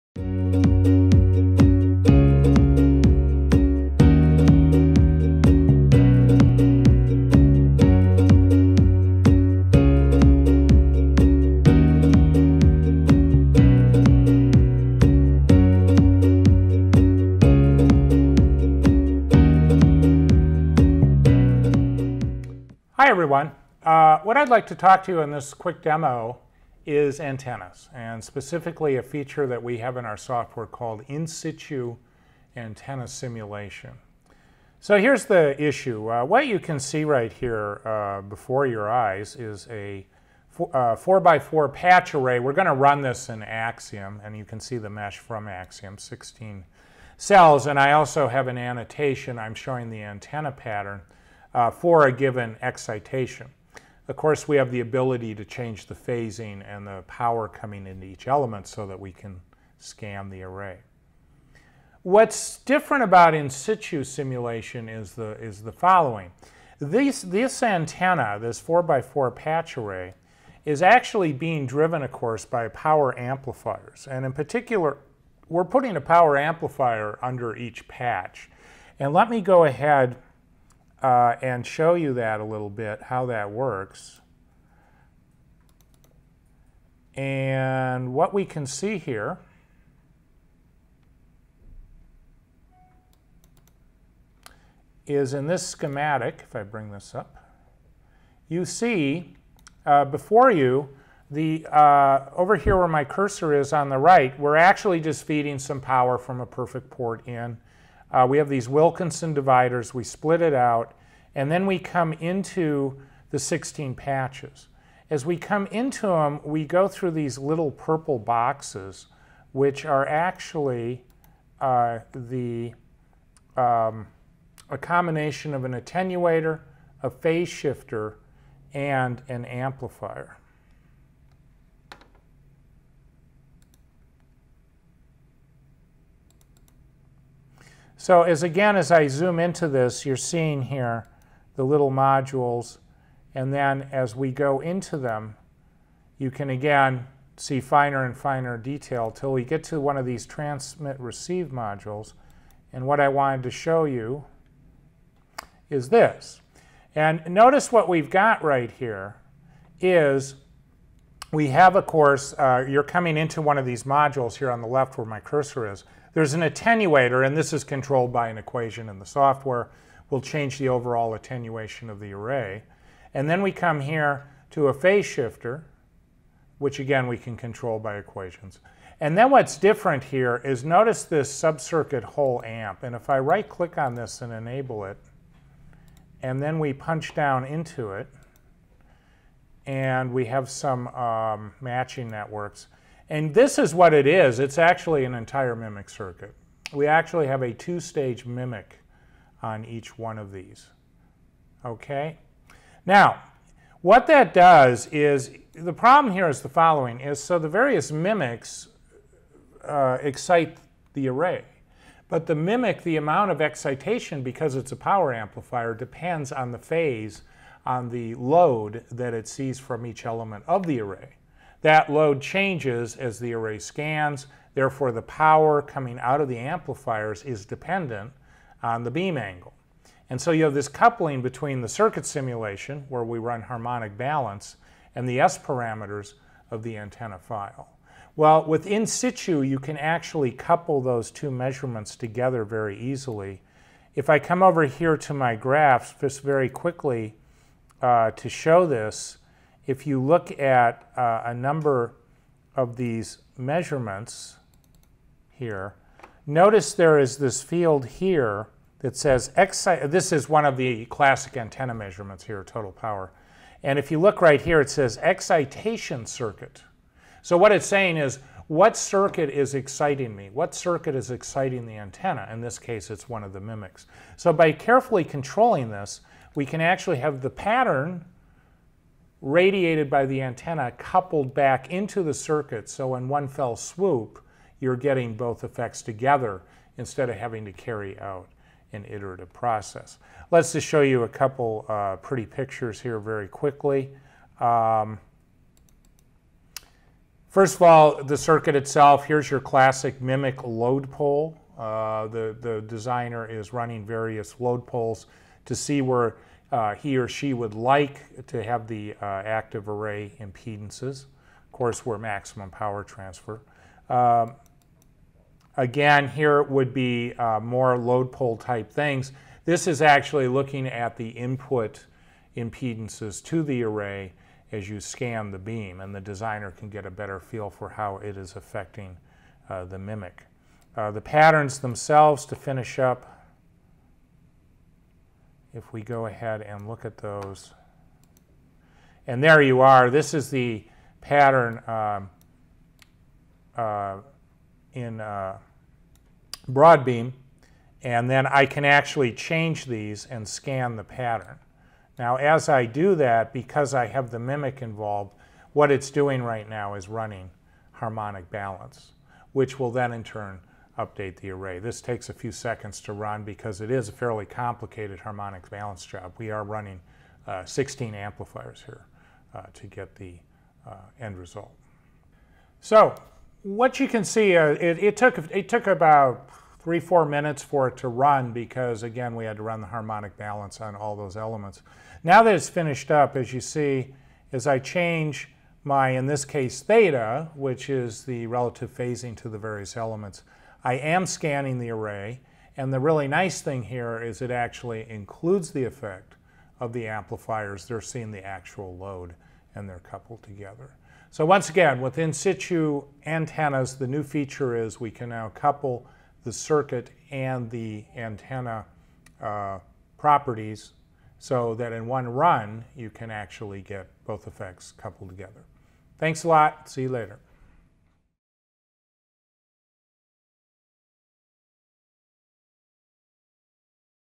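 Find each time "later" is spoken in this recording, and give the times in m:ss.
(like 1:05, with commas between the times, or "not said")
6:56.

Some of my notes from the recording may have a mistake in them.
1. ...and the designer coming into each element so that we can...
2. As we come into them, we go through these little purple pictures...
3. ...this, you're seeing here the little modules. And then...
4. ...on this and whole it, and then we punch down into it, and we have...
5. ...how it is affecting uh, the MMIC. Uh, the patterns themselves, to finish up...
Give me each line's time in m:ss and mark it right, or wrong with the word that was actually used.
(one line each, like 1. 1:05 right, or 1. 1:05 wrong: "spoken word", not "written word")
1. 0:56 wrong: "power", not "designer"
2. 1:55 wrong: "boxes", not "pictures"
3. 2:19 right
4. 3:03 wrong: "enable", not "whole"
5. 5:27 right.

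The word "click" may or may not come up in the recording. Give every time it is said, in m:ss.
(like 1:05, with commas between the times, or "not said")
3:03.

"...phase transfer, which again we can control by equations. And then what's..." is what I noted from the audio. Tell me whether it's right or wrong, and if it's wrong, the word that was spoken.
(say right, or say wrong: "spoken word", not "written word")
wrong: "shifter", not "transfer".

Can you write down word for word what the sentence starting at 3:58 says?
Well, with in situ, you can actually couple those two measurements together very easily.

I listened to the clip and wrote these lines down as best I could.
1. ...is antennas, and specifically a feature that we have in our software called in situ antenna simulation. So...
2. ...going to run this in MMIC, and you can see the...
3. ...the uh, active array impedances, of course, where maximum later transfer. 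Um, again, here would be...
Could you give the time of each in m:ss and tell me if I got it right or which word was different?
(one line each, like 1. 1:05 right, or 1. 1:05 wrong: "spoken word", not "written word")
1. 0:26 right
2. 0:42 wrong: "AXIEM", not "MMIC"
3. 5:08 wrong: "power", not "later".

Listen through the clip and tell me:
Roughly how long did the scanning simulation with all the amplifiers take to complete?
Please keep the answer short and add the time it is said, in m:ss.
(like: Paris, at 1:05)
3 to 4 minutes, at 6:16.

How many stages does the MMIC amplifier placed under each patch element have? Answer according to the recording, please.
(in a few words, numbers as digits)
2.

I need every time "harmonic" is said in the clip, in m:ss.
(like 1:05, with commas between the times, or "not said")
3:53, 5:57, 6:04, 6:19.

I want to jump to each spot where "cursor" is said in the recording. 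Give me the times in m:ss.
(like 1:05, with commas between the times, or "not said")
1:43, 2:45.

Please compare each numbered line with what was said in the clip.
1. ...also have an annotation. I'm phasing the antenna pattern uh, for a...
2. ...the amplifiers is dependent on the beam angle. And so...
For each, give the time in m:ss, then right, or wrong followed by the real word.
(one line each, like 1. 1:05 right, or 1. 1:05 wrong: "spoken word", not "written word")
1. 0:47 wrong: "showing", not "phasing"
2. 3:46 right.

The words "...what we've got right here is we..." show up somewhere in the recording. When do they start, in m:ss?
2:37.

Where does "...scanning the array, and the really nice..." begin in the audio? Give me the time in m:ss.
6:31.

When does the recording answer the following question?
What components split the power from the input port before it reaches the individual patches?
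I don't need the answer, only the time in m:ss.
1:48.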